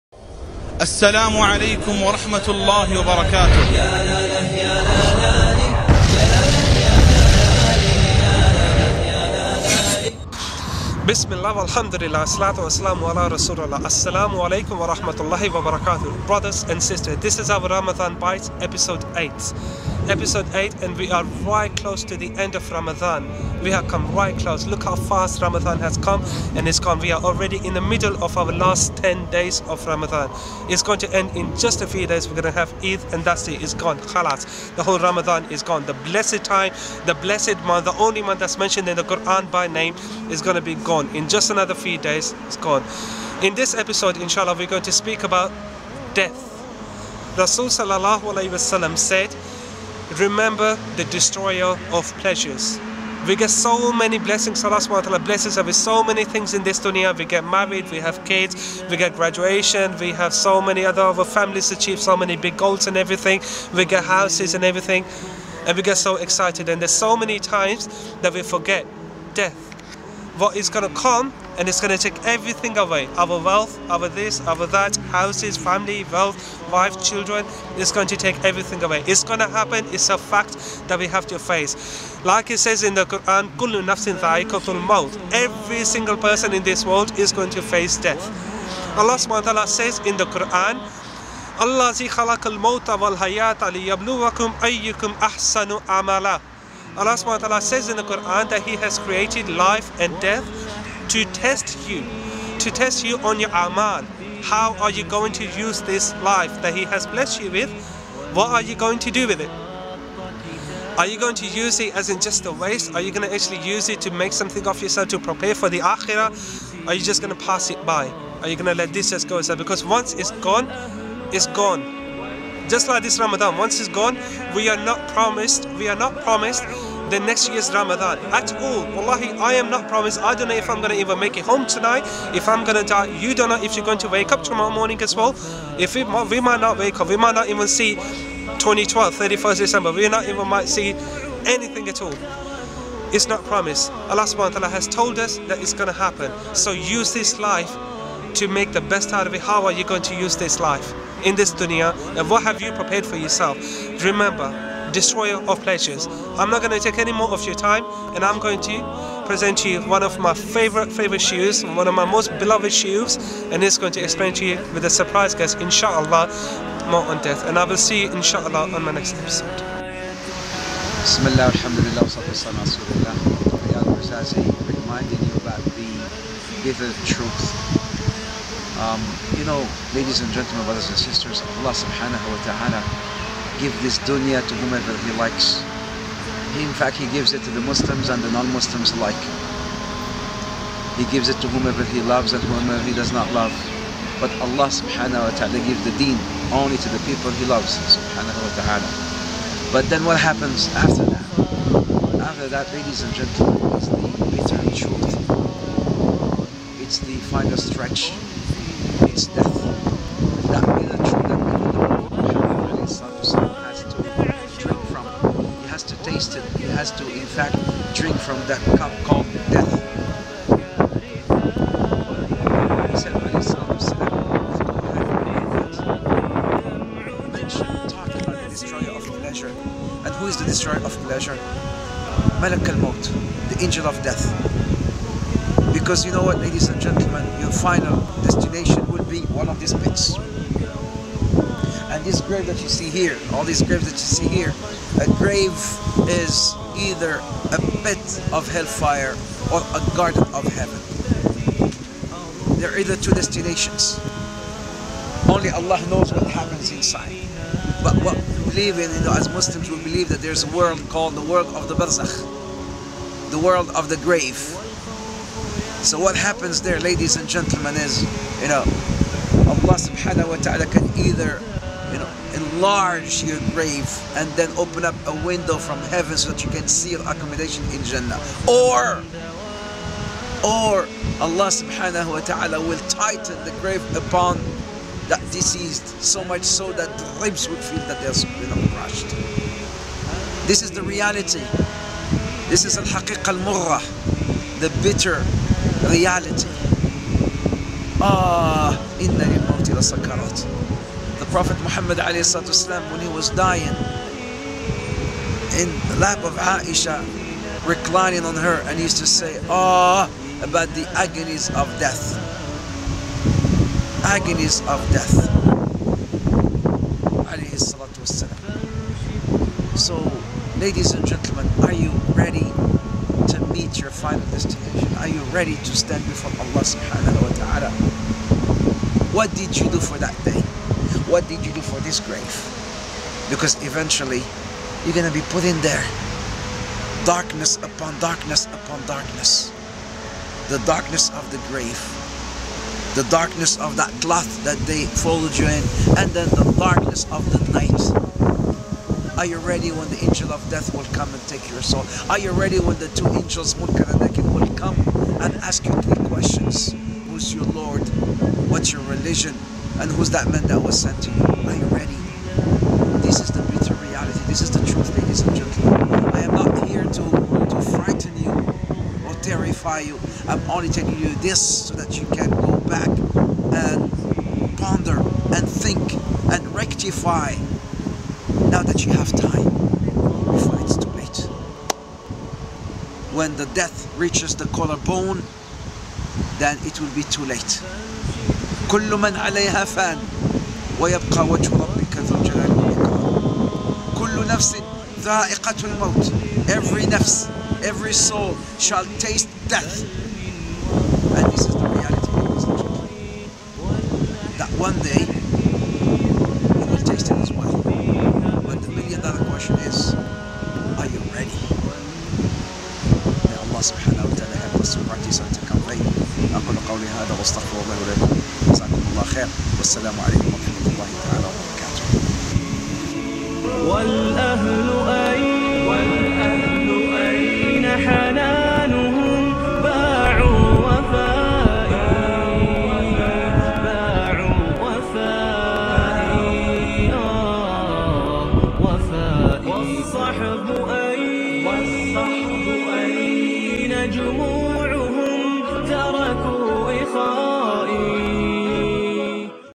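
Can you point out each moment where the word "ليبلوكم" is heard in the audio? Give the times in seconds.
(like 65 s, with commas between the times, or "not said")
93 s.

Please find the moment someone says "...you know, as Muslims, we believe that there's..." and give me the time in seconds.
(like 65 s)
258 s.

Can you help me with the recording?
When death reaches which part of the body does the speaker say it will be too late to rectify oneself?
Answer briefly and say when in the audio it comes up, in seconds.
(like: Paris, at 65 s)
the collarbone, at 384 s.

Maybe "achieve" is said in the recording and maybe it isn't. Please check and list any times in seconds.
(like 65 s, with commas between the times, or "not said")
61 s.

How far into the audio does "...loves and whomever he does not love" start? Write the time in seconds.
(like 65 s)
192 s.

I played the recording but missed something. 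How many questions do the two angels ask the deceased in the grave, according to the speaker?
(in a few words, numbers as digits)
3.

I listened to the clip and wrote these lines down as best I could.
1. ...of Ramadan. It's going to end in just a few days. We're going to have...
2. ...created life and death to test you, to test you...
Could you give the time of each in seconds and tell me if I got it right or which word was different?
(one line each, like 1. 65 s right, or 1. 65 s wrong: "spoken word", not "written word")
1. 29 s right
2. 98 s right.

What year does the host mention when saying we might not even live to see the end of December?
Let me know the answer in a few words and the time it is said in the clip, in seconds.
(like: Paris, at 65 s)
2012, at 137 s.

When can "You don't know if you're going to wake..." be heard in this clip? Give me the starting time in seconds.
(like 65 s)
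133 s.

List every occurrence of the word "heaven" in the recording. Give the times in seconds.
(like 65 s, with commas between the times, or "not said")
250 s, 275 s.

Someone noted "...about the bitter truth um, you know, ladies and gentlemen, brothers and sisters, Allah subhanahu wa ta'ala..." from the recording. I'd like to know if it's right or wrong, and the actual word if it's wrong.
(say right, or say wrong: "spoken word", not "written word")
right.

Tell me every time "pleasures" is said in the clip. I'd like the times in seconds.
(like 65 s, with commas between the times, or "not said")
52 s, 155 s, 231 s.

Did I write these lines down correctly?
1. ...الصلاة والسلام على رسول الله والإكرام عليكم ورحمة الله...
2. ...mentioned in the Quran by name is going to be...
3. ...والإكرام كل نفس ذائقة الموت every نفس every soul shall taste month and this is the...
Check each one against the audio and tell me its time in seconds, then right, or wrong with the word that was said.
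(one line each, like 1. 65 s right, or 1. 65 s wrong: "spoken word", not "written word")
1. 12 s wrong: "السلام", not "والإكرام"
2. 38 s right
3. 392 s wrong: "death", not "month".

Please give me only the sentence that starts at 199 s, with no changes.
But then what happens after that?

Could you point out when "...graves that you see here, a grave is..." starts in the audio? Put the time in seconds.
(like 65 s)
243 s.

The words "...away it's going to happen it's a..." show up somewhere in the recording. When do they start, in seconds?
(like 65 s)
78 s.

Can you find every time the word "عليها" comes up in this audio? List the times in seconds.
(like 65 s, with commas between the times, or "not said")
389 s.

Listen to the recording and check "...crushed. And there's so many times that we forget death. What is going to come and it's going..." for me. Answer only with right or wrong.
wrong.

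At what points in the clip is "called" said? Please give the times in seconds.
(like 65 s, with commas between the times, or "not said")
219 s, 260 s.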